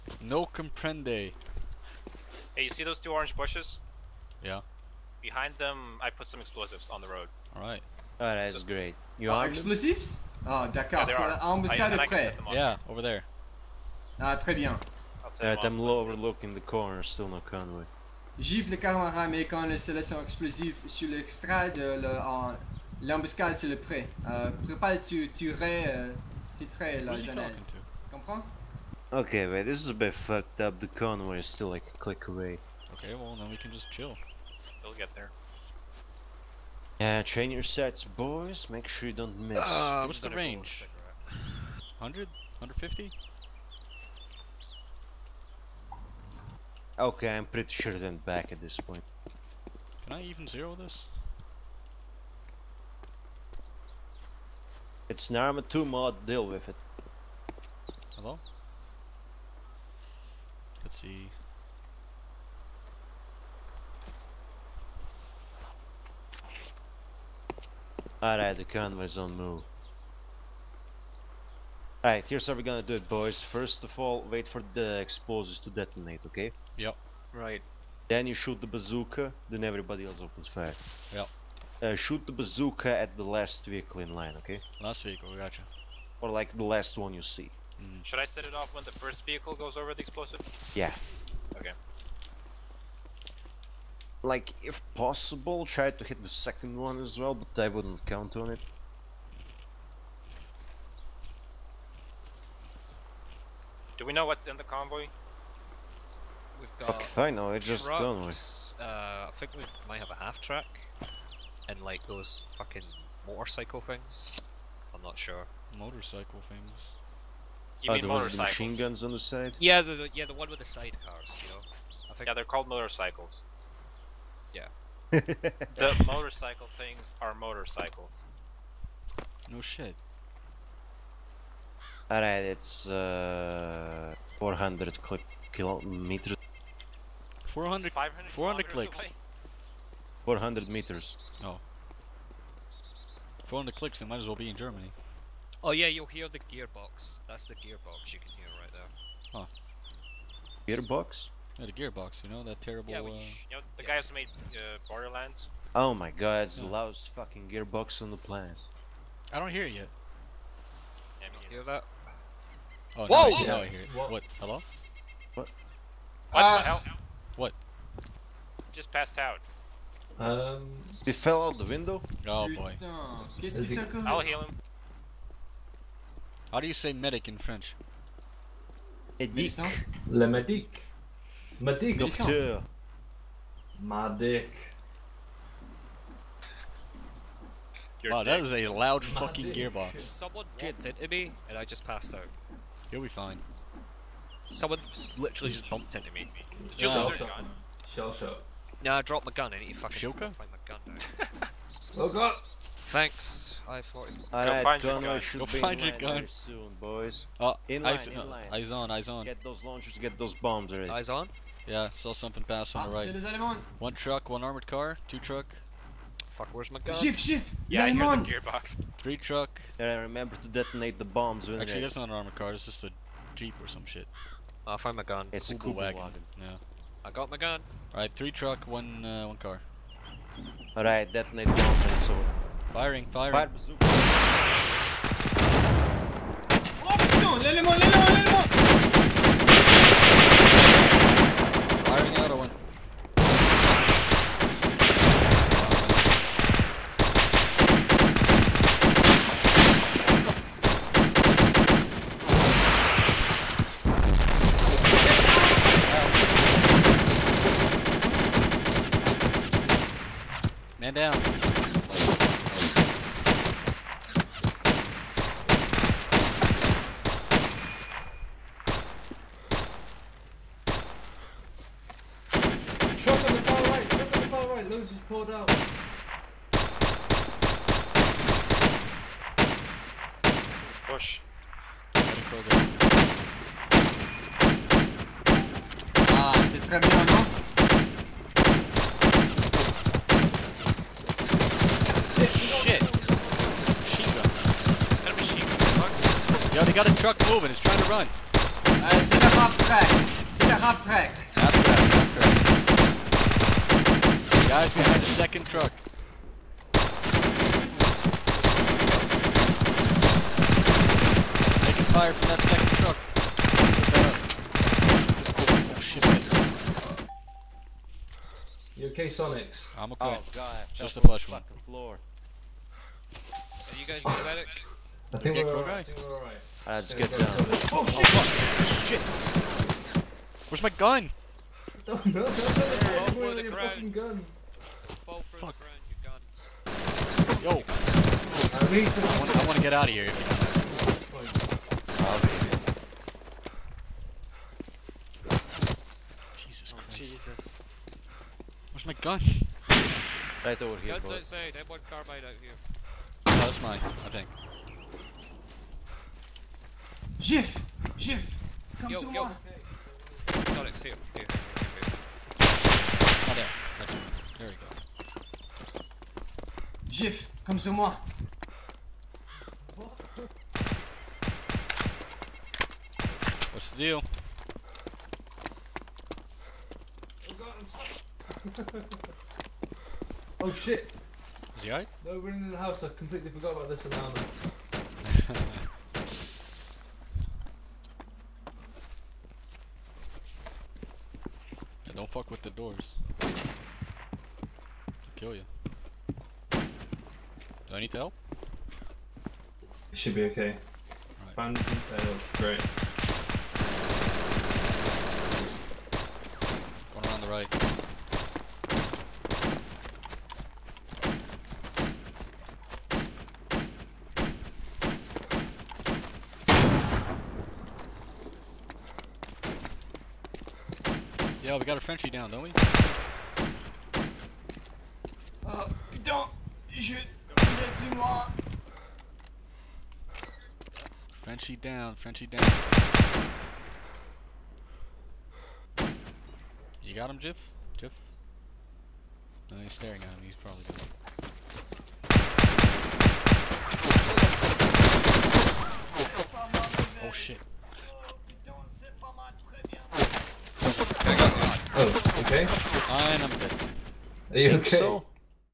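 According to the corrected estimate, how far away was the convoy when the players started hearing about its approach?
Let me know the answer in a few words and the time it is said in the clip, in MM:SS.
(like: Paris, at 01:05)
400 meters, at 02:20.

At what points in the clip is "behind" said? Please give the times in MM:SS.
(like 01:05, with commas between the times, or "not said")
00:05, 05:04.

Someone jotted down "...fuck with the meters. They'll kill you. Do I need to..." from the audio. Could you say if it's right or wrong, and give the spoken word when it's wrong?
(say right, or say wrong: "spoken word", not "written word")
wrong: "doors", not "meters".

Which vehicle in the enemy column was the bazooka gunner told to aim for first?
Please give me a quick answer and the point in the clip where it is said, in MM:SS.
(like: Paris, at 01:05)
The last vehicle, at 01:23.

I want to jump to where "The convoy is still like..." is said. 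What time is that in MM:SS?
00:30.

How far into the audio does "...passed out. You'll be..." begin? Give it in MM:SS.
03:11.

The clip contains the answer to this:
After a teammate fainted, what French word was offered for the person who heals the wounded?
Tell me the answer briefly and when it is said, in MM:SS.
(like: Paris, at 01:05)
Docteur, at 03:01.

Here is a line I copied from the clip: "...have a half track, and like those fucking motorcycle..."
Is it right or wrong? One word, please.
right.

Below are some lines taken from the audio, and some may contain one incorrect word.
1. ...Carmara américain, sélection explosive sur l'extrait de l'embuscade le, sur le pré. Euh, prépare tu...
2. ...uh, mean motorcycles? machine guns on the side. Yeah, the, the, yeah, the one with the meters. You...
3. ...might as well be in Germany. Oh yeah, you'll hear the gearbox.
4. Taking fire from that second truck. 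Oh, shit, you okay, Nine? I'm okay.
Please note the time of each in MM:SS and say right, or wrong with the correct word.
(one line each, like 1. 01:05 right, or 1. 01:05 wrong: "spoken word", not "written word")
1. 00:18 right
2. 01:57 wrong: "sidecars", not "meters"
3. 02:24 right
4. 05:11 wrong: "Sonix", not "Nine".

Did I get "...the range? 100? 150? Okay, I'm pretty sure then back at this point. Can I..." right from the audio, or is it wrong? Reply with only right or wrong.
right.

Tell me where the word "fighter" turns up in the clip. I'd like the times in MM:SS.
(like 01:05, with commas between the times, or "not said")
not said.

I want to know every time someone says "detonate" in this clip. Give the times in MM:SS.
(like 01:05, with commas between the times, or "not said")
01:15, 03:40, 03:51.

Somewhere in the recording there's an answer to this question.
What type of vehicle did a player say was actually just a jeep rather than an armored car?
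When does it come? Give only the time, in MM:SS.
03:45.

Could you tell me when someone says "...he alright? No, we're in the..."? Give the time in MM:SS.
06:21.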